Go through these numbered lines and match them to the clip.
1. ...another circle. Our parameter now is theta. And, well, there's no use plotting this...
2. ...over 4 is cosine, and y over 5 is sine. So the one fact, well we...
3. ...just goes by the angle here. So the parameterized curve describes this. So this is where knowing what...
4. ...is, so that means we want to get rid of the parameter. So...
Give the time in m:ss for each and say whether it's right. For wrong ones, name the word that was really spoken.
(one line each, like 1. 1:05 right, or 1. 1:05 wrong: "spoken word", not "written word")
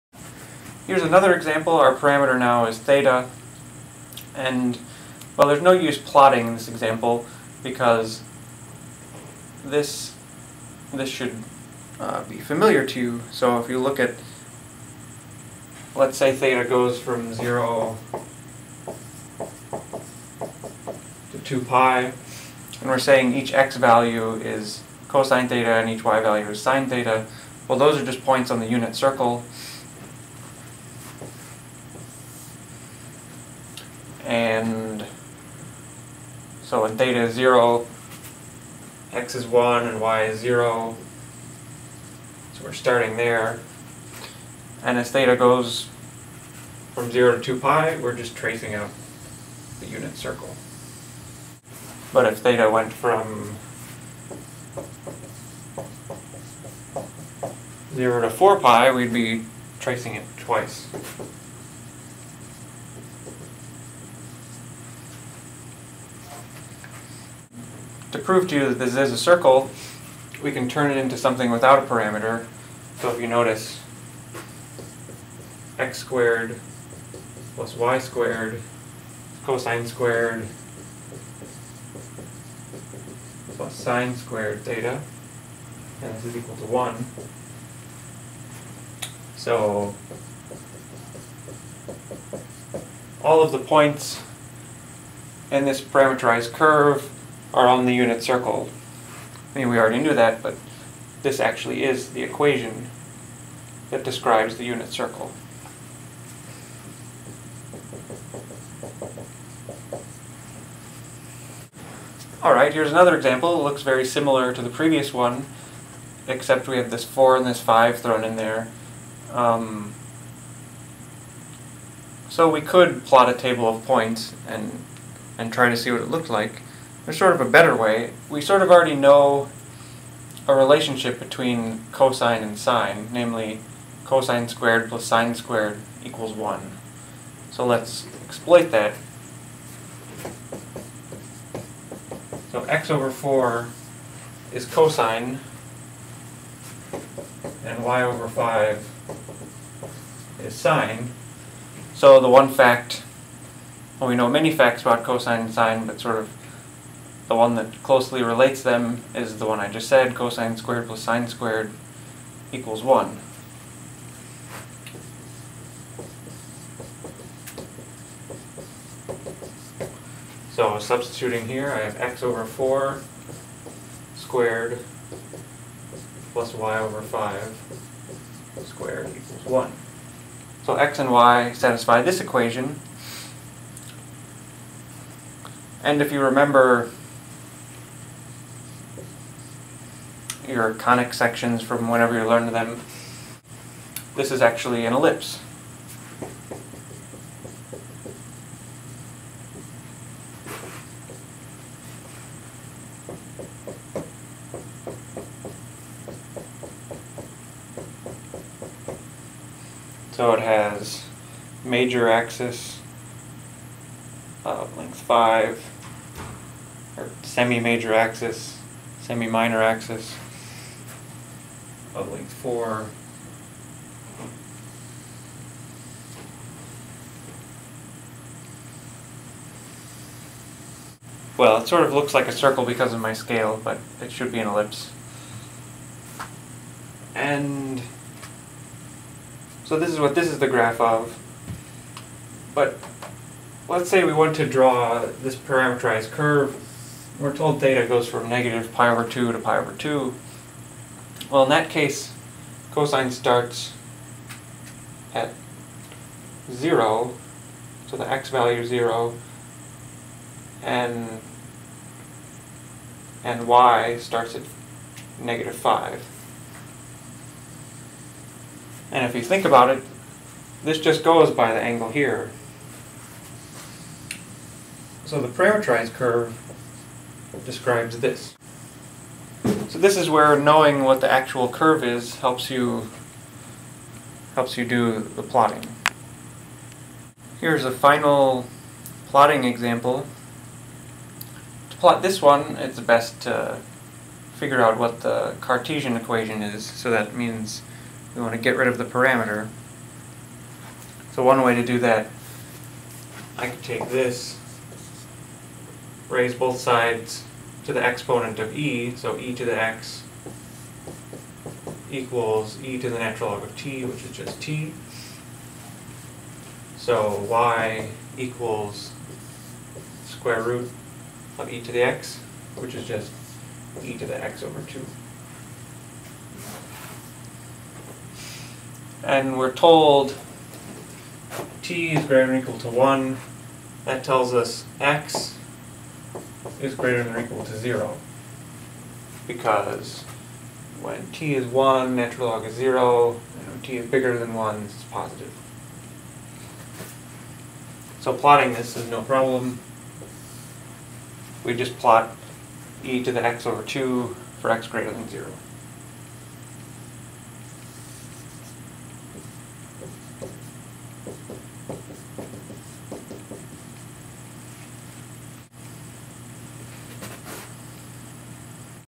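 1. 0:01 wrong: "example", not "circle"
2. 2:22 right
3. 4:30 right
4. 4:56 right.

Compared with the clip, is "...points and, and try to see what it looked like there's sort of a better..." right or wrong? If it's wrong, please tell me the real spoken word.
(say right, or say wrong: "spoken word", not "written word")
right.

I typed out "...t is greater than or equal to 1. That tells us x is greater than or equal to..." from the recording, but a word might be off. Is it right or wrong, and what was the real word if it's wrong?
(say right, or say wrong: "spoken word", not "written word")
right.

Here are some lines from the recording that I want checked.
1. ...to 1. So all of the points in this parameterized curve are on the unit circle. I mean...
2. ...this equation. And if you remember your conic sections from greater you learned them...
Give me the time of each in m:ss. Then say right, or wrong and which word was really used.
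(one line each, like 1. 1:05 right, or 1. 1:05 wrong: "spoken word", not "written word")
1. 1:26 right
2. 3:02 wrong: "whenever", not "greater".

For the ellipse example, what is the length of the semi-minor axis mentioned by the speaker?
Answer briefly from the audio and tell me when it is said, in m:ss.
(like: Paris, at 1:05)
4, at 3:42.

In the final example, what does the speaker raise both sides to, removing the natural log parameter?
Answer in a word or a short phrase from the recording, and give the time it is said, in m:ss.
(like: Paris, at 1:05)
exponent of e, at 5:07.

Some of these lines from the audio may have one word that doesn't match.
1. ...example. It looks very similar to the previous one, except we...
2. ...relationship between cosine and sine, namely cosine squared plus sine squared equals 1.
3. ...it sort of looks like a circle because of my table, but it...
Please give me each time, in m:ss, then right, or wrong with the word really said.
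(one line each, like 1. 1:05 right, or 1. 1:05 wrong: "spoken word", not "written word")
1. 1:53 right
2. 2:10 right
3. 3:51 wrong: "scale", not "table".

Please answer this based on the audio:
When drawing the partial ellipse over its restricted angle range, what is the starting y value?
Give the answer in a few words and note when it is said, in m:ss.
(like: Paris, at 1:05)
-5, at 4:25.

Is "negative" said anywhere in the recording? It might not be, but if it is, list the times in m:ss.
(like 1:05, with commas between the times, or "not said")
4:08, 4:25.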